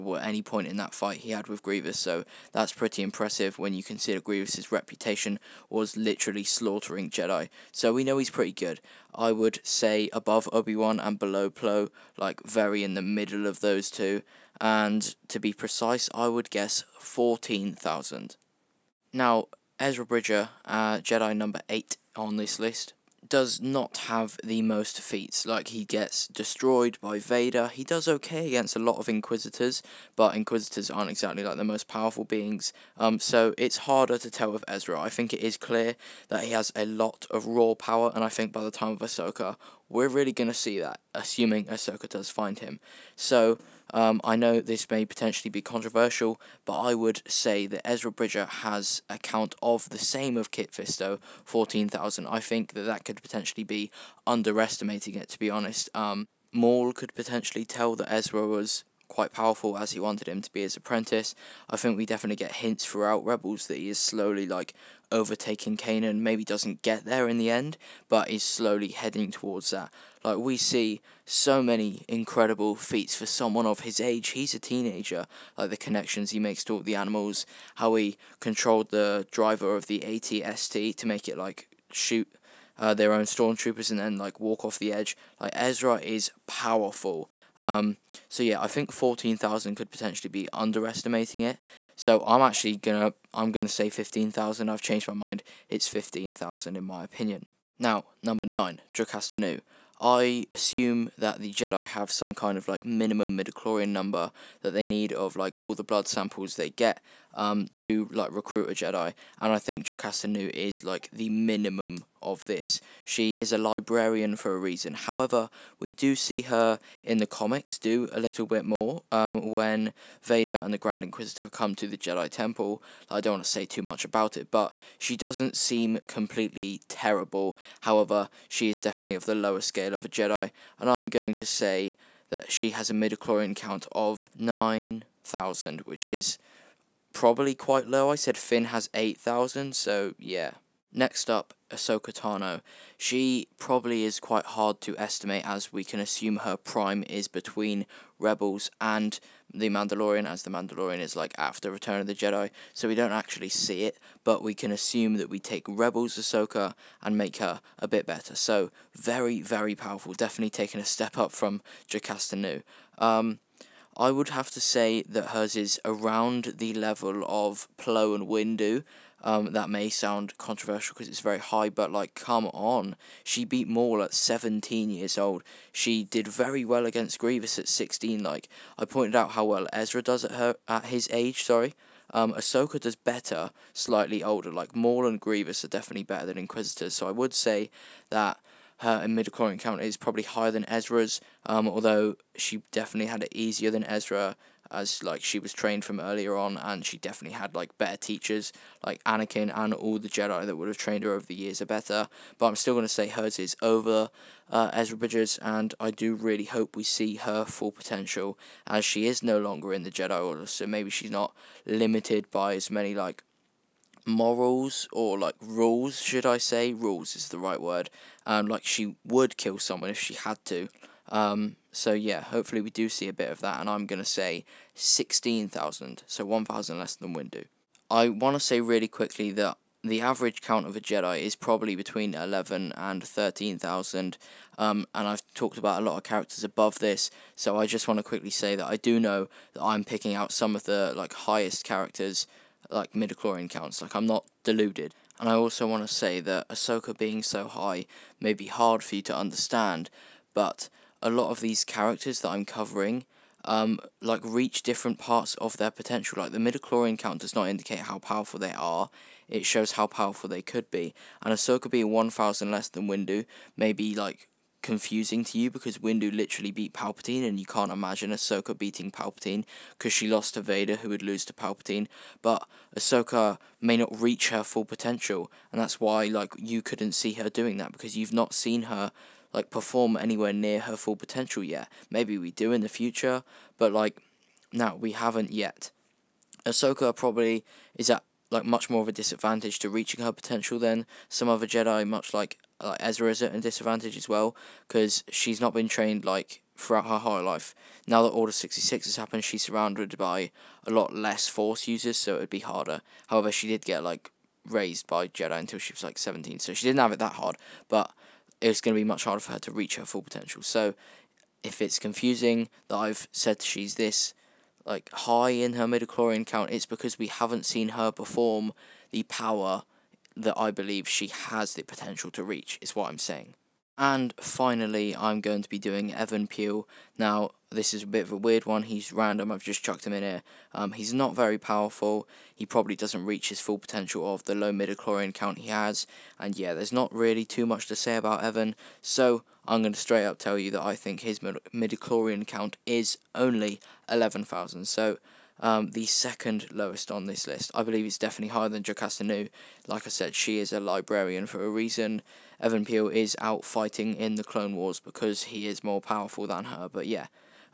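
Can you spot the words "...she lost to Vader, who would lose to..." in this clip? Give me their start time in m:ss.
4:29.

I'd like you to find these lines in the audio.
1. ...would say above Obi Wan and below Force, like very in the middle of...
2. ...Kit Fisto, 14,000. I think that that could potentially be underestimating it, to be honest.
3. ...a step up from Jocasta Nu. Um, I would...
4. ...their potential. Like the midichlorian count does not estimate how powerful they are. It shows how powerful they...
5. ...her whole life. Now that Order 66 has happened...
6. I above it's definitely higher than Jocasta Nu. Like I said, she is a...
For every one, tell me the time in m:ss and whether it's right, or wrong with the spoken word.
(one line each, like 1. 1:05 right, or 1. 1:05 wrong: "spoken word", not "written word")
1. 0:09 wrong: "Plo", not "Force"
2. 0:50 right
3. 2:40 right
4. 4:15 wrong: "indicate", not "estimate"
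5. 4:56 right
6. 5:47 wrong: "believe", not "above".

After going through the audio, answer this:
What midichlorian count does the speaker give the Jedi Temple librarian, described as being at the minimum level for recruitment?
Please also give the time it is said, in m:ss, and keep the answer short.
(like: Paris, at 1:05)
9,000, at 2:14.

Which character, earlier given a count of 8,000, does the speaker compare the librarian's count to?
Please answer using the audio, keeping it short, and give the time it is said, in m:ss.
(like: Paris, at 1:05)
Finn, at 2:18.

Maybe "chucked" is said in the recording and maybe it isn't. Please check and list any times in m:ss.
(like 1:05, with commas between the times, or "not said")
5:29.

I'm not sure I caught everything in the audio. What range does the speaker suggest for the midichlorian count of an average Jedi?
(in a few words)
11,000 to 13,000.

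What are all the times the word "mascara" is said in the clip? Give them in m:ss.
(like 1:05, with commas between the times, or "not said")
not said.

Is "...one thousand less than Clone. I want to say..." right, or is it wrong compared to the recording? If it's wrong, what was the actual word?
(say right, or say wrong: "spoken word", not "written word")
wrong: "Windu", not "Clone".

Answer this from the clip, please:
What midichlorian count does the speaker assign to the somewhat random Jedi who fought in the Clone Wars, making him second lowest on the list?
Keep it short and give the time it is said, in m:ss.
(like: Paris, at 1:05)
11,000, at 5:43.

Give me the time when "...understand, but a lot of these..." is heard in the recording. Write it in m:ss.
4:09.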